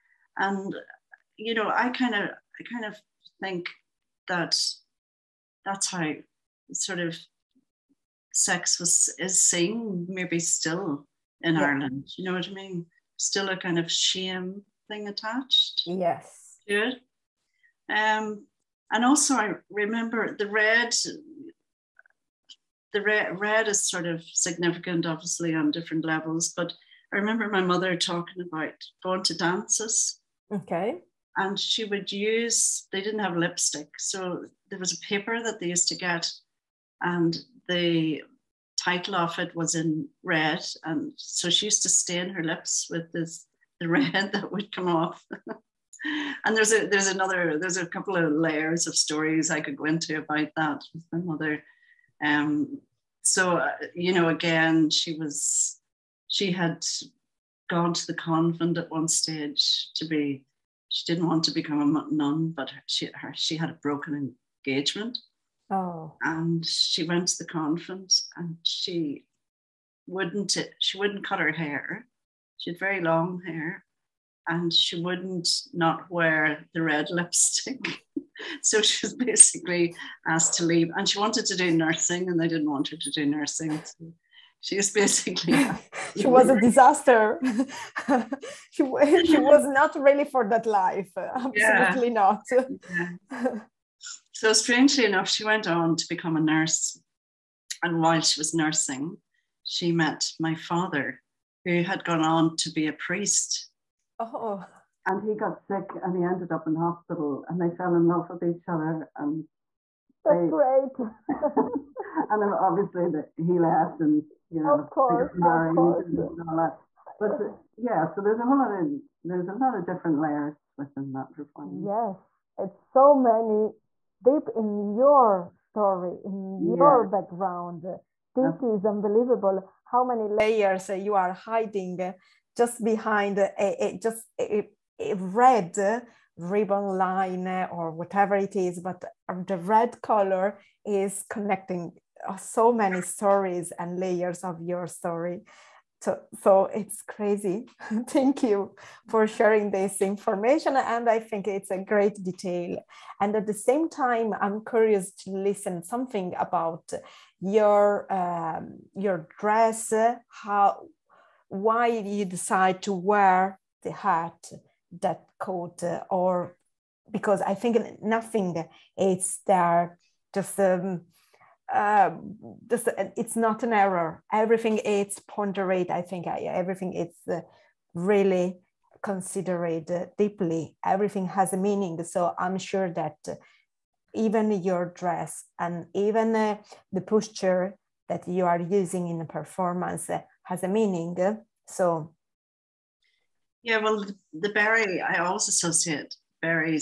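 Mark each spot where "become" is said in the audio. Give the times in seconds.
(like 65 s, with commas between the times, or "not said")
61 s, 96 s.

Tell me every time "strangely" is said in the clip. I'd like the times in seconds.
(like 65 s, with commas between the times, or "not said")
94 s.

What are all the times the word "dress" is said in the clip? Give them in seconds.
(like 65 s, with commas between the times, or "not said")
159 s, 184 s.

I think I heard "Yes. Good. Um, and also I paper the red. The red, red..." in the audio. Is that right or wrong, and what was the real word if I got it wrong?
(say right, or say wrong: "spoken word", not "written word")
wrong: "remember", not "paper".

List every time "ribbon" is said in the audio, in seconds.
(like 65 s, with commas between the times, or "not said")
136 s.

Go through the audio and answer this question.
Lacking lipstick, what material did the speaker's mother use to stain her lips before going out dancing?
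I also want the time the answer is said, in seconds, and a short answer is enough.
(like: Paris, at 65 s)
paper, at 35 s.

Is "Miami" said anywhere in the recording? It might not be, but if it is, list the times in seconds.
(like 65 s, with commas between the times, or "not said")
not said.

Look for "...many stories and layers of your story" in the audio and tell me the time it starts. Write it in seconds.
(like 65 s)
142 s.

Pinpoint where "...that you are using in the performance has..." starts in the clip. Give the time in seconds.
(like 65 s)
188 s.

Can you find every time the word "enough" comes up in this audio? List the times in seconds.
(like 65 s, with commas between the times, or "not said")
95 s.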